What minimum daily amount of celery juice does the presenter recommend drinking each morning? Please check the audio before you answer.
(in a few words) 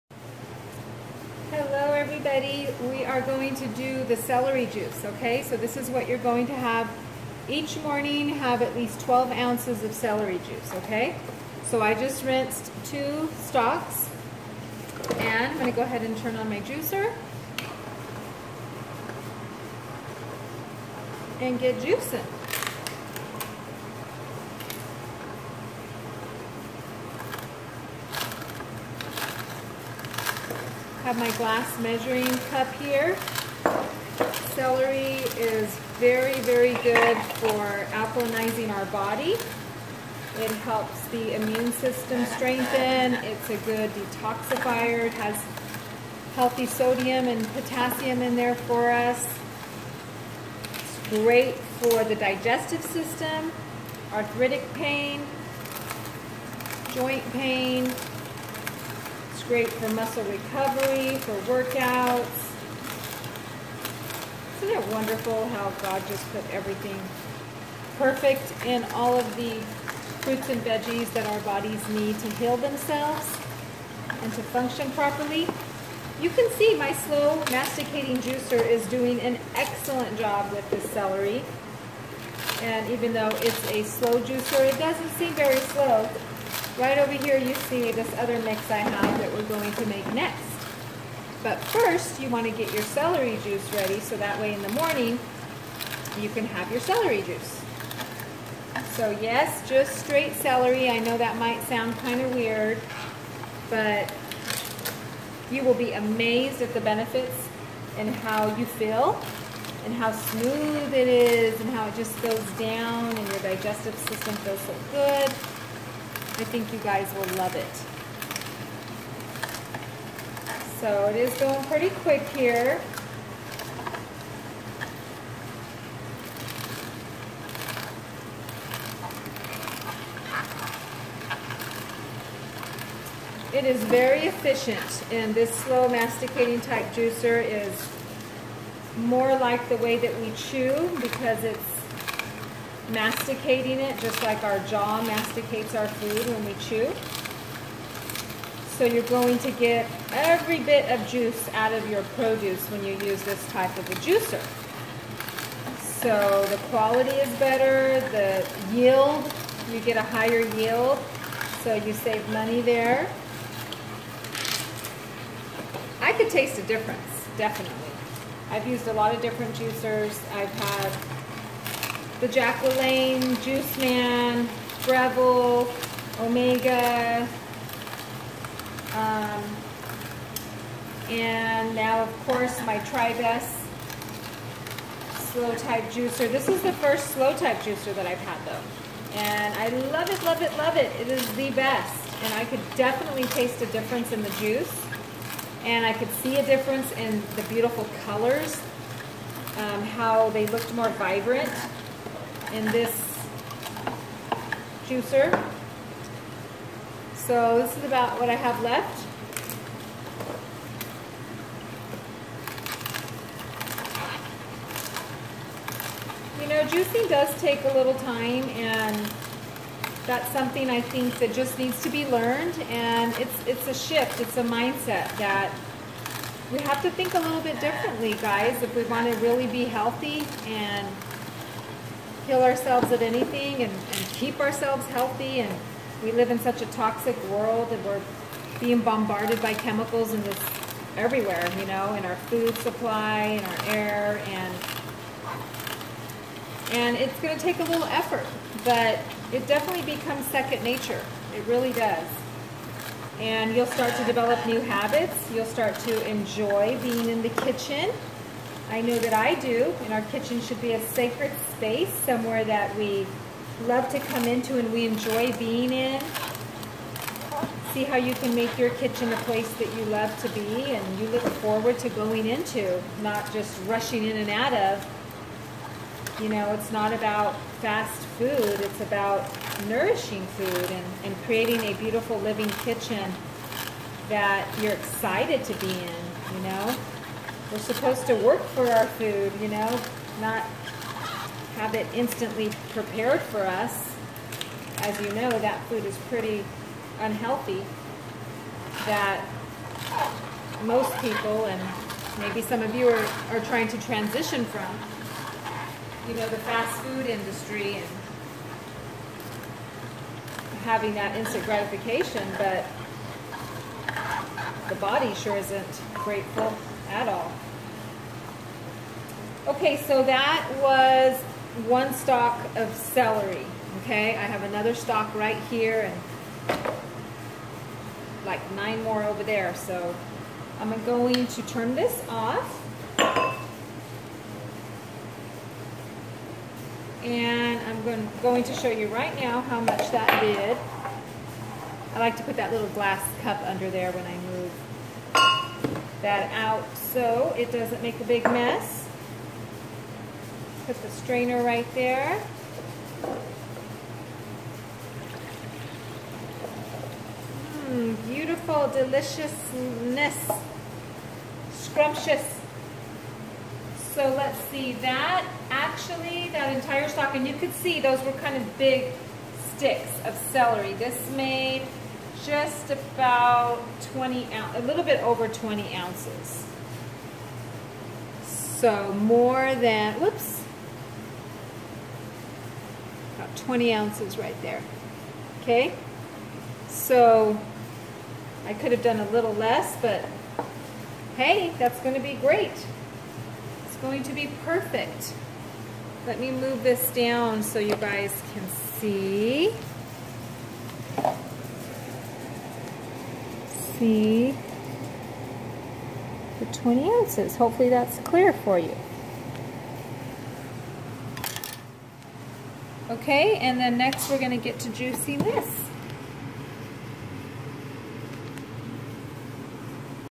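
12 ounces.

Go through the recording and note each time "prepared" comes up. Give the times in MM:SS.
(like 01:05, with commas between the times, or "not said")
04:52.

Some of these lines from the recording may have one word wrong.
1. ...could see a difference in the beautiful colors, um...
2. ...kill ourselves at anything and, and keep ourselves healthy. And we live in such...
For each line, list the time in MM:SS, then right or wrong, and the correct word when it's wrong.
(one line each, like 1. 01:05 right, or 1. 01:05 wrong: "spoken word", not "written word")
1. 03:15 right
2. 03:52 right.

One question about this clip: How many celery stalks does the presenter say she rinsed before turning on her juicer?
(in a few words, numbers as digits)
2.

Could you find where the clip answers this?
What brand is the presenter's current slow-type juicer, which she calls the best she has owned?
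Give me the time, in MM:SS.
03:02.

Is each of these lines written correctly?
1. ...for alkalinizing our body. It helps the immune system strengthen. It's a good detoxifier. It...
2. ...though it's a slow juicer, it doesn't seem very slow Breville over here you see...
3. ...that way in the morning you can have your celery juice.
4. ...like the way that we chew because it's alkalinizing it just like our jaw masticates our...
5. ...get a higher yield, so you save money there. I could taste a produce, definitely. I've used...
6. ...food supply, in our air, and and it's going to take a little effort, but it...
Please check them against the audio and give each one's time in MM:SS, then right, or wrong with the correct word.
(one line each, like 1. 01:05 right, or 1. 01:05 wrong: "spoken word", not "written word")
1. 00:37 right
2. 01:23 wrong: "Right", not "Breville"
3. 01:34 right
4. 02:19 wrong: "masticating", not "alkalinizing"
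5. 02:39 wrong: "difference", not "produce"
6. 04:02 right.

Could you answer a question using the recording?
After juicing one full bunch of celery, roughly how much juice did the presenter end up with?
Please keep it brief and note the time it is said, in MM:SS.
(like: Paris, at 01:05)
20 ounces, at 06:13.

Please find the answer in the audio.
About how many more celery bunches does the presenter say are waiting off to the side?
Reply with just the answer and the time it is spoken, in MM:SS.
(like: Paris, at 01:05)
9, at 05:28.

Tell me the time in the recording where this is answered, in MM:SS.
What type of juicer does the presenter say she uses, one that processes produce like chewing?
01:16.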